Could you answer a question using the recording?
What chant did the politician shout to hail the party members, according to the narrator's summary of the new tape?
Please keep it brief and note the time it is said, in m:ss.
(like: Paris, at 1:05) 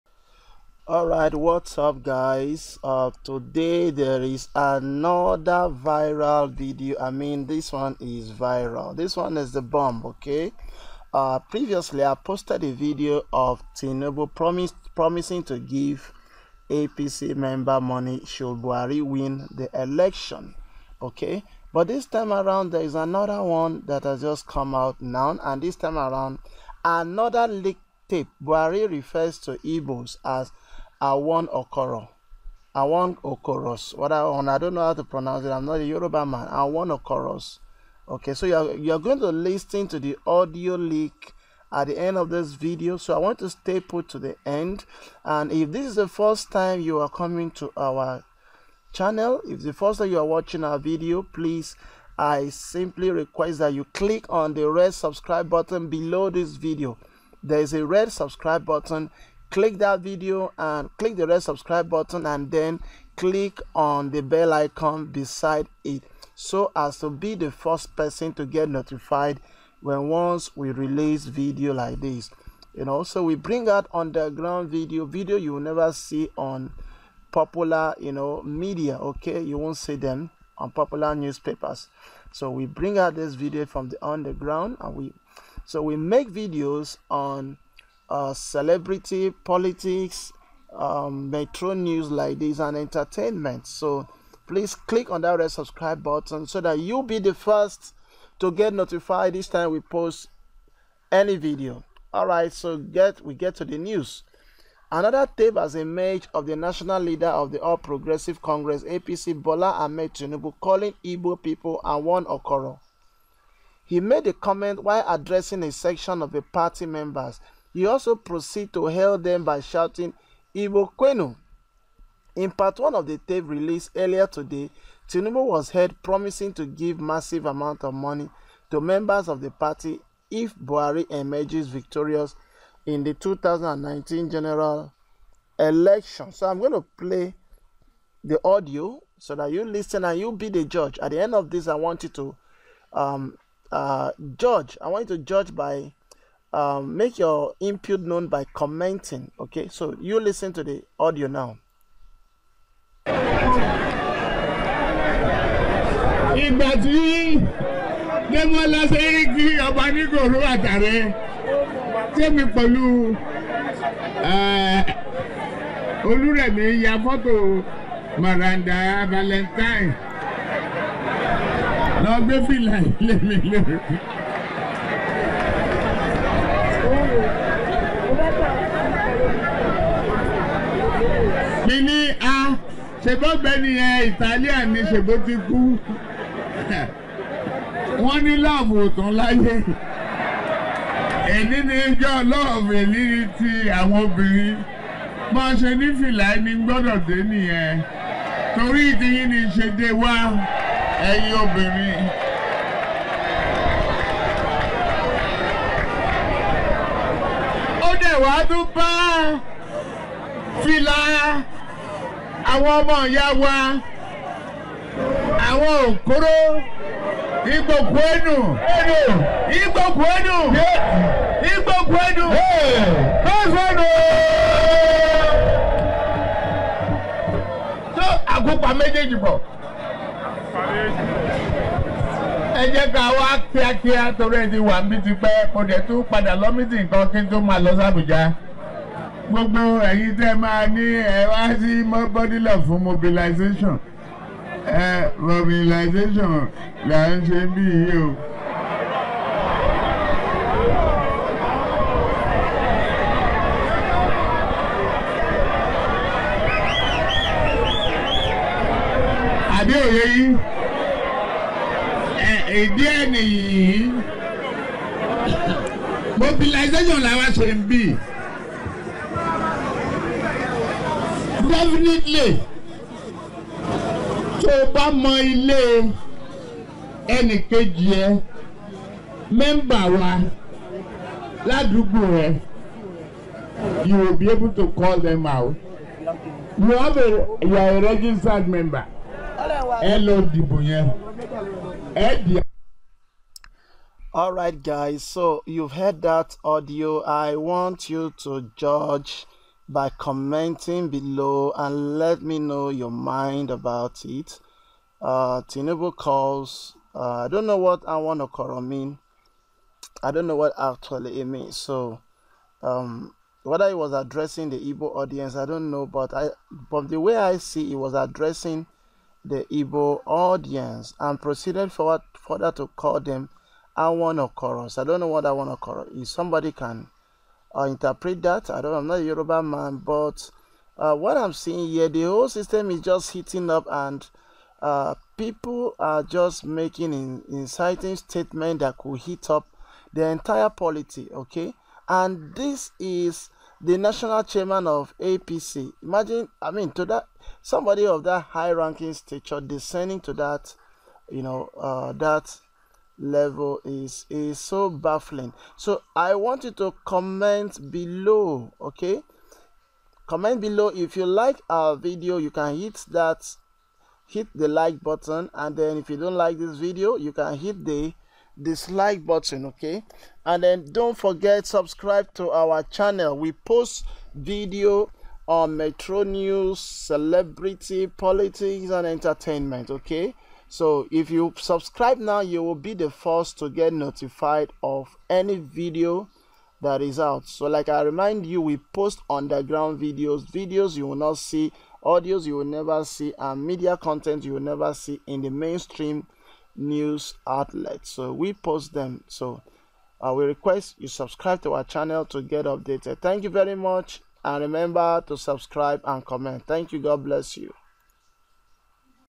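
Ibokwenu, at 2:00.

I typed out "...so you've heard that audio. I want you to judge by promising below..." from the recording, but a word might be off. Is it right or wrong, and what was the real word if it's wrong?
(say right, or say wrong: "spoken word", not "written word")
wrong: "commenting", not "promising".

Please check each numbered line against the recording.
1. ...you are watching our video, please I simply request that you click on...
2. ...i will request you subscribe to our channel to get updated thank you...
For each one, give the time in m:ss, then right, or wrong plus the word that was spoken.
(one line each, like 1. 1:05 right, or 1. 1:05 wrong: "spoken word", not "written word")
1. 0:50 right
2. 6:40 right.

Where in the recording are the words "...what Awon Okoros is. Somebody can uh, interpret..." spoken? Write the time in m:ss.
5:25.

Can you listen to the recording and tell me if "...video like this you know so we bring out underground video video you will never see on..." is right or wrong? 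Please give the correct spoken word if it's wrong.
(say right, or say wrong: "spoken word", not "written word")
right.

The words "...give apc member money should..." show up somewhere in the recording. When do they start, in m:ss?
0:15.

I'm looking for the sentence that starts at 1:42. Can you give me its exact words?
All right, so get we get to the news.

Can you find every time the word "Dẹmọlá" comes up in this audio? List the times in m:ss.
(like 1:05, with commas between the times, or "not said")
2:38.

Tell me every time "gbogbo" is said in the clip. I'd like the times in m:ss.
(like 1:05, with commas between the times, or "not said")
3:59.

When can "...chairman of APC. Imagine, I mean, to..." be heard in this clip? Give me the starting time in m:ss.
5:44.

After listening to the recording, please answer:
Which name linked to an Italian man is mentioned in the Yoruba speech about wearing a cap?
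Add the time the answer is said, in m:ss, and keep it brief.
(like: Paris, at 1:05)
Maranda Valentine, at 2:48.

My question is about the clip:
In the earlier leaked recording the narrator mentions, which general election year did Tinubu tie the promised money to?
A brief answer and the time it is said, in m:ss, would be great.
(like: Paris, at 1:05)
2019, at 2:13.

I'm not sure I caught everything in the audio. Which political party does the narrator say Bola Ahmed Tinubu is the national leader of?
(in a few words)
All Progressive Congress.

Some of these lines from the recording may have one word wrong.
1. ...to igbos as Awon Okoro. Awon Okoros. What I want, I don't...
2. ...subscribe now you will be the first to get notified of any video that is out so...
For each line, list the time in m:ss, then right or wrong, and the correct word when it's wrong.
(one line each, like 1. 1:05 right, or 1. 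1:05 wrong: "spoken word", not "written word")
1. 0:29 right
2. 6:21 right.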